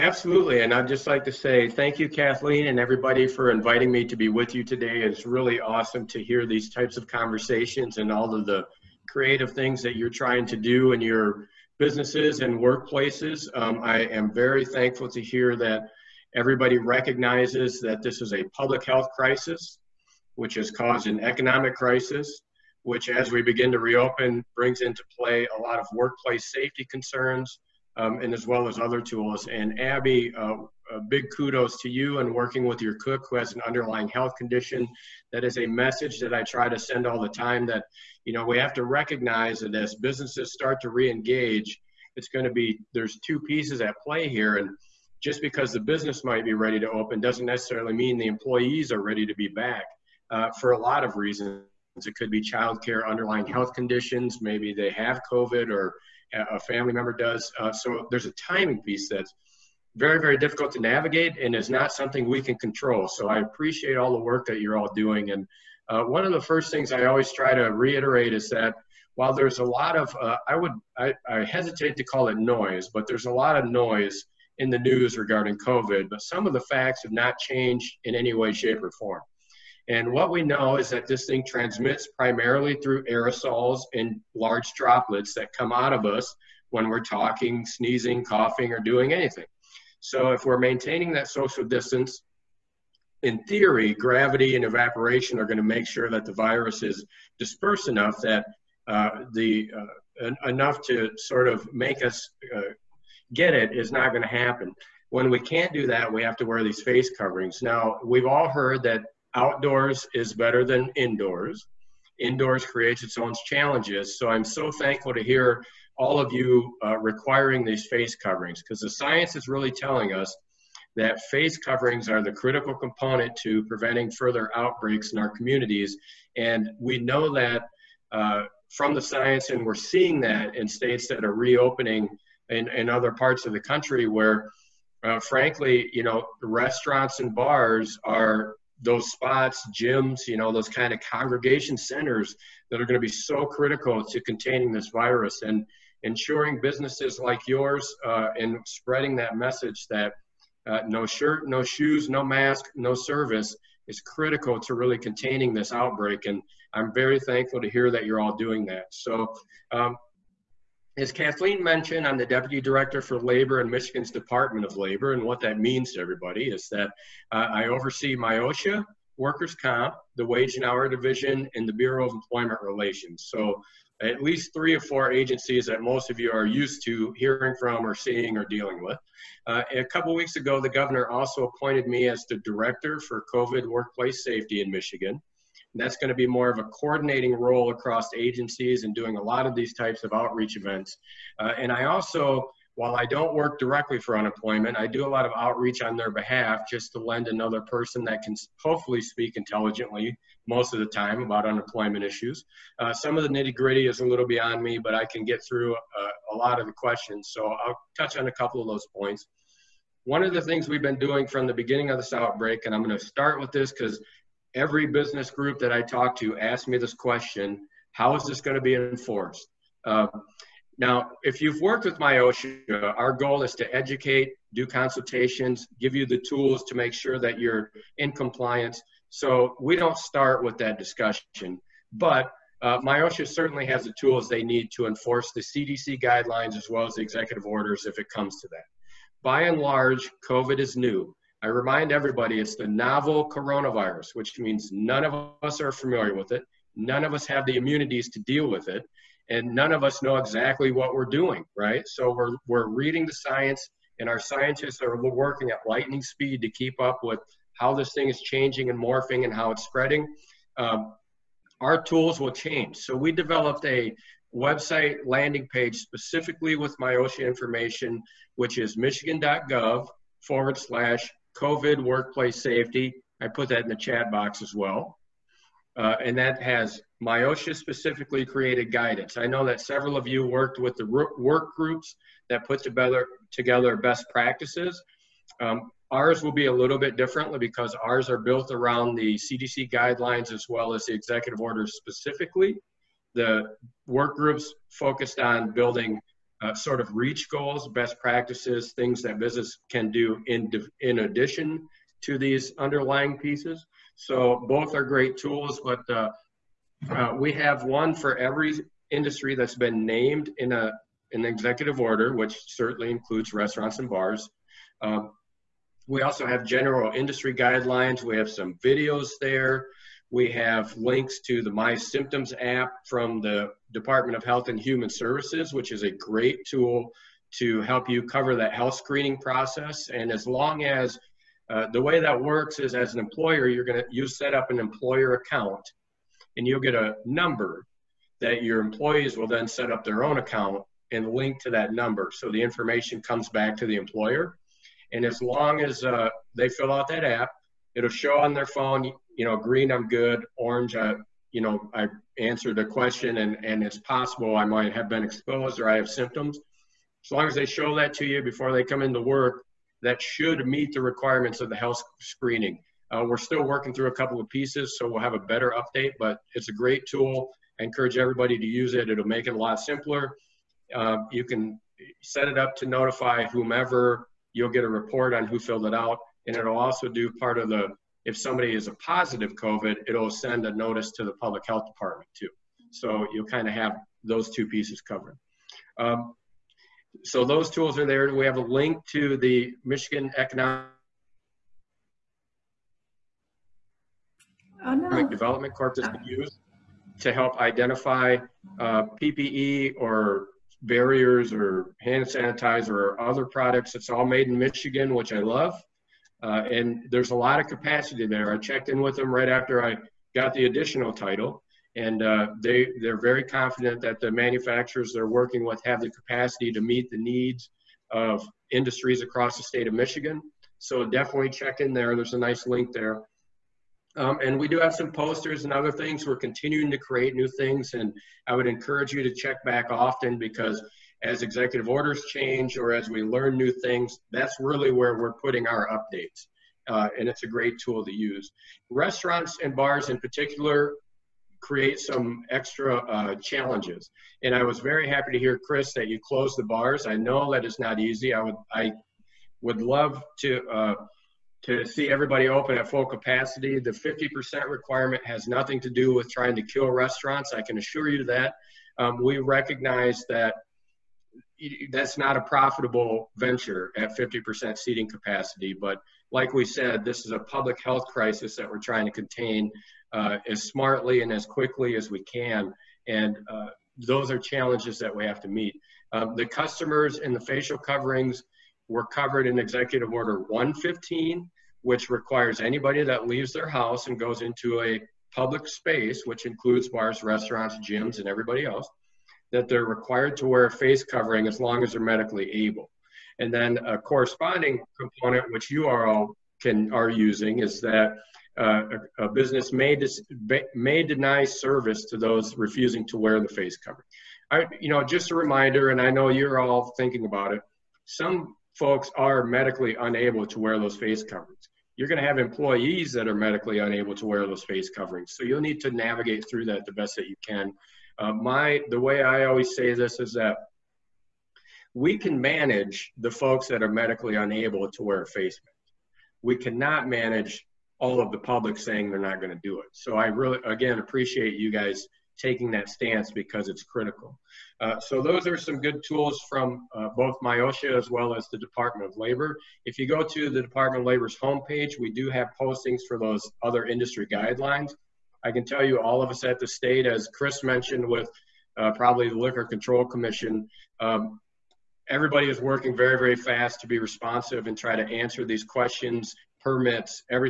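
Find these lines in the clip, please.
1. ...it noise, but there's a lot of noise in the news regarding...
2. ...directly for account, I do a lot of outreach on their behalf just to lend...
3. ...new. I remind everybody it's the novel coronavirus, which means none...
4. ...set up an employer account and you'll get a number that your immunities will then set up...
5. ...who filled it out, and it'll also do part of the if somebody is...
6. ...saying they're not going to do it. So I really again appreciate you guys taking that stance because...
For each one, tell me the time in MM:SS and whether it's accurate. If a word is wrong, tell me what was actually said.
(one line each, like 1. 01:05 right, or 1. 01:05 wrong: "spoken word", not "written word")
1. 01:12 right
2. 03:13 wrong: "unemployment", not "account"
3. 04:00 right
4. 05:34 wrong: "employees", not "immunities"
5. 06:15 right
6. 08:48 right.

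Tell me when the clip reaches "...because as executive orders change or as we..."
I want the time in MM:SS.
07:10.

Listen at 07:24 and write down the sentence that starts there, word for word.
And I was very happy to hear, Chris, that you closed the bars.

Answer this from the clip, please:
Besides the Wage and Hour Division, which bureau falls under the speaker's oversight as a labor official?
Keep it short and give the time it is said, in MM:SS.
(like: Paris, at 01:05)
Bureau of Employment Relations, at 02:51.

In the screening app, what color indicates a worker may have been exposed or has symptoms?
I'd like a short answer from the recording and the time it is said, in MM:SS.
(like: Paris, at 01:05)
Orange, at 05:50.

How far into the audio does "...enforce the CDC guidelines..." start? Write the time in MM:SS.
03:54.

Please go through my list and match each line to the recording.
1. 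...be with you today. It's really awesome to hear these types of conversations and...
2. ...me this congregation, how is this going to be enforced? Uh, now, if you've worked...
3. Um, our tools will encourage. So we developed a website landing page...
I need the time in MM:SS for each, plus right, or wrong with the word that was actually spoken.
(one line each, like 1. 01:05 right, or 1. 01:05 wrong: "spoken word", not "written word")
1. 00:04 right
2. 03:36 wrong: "question", not "congregation"
3. 04:20 wrong: "change", not "encourage".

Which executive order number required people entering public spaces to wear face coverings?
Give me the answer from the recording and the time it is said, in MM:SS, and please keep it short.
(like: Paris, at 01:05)
115, at 08:00.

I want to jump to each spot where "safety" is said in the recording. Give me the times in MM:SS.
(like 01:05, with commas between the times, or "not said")
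00:26, 03:04, 04:32.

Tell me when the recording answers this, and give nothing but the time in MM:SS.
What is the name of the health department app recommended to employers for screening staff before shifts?
05:21.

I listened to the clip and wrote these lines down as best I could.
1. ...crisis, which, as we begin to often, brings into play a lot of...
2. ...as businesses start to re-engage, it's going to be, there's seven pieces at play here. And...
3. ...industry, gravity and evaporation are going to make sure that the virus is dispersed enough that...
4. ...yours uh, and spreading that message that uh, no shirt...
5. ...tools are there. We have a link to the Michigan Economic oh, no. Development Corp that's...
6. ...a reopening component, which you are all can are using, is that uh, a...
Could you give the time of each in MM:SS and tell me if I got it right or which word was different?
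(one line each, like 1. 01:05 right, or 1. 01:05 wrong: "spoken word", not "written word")
1. 00:21 wrong: "reopen", not "often"
2. 00:39 wrong: "two", not "seven"
3. 01:33 wrong: "theory", not "industry"
4. 02:27 right
5. 06:27 right
6. 08:13 wrong: "corresponding", not "reopening".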